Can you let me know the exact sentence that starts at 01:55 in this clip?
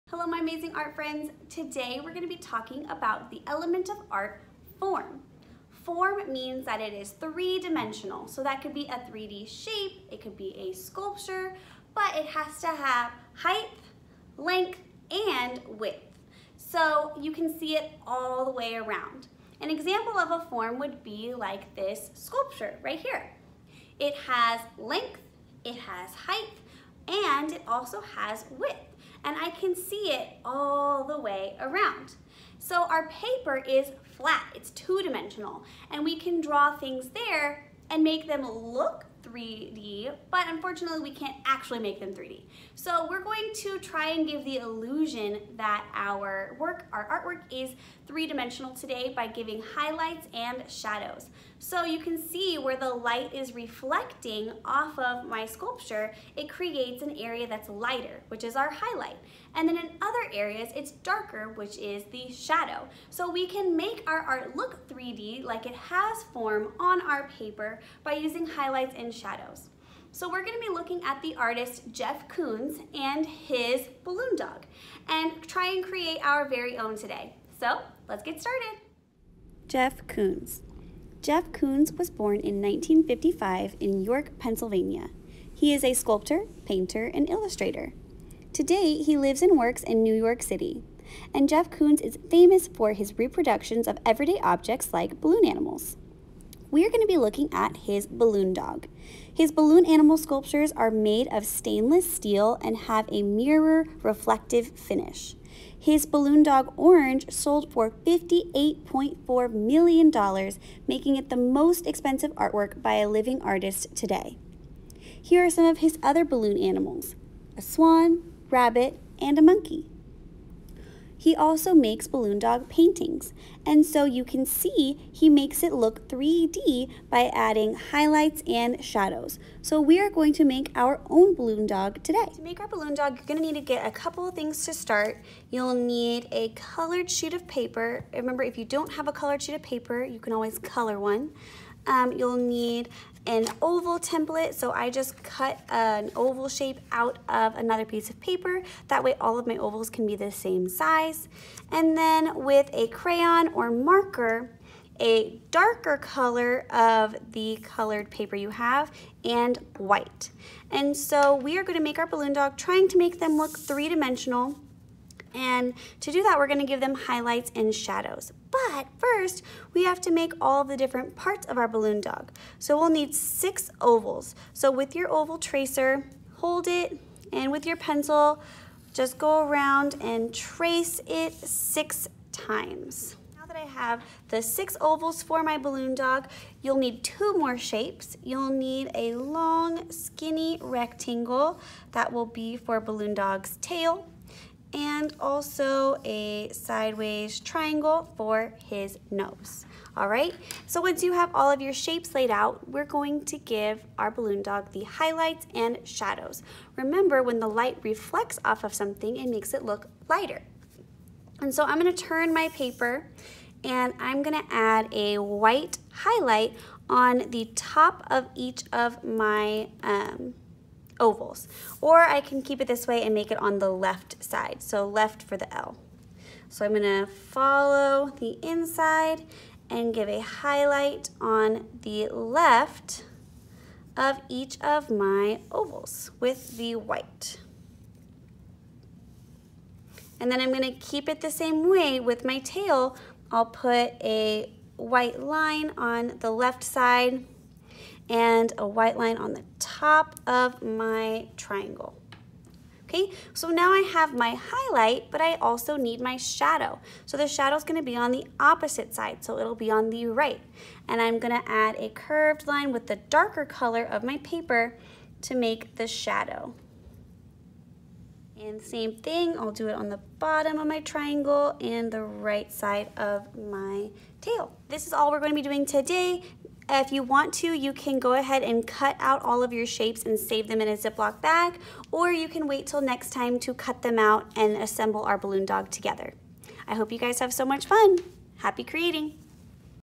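Here are some of his other balloon animals, a swan, rabbit, and a monkey.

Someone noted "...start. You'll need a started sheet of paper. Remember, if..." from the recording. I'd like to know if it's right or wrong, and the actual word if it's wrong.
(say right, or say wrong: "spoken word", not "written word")
wrong: "colored", not "started".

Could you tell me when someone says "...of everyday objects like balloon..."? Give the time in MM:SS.
01:33.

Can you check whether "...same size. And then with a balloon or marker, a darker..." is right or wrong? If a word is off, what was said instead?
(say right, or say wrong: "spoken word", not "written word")
wrong: "crayon", not "balloon".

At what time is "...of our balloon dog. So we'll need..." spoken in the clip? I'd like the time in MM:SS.
02:51.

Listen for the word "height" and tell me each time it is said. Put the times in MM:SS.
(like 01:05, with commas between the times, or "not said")
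00:13, 00:26.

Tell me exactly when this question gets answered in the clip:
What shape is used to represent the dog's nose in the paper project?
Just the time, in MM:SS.
03:16.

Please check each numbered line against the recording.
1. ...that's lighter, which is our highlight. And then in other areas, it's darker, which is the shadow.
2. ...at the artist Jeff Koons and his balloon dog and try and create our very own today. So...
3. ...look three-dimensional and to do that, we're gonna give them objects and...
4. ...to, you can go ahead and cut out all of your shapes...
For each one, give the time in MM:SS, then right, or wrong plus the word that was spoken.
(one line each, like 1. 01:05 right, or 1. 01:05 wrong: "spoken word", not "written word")
1. 00:57 right
2. 01:11 right
3. 02:43 wrong: "highlights", not "objects"
4. 04:37 right.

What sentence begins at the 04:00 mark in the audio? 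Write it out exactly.
And then I'm gonna keep it the same way with my tail.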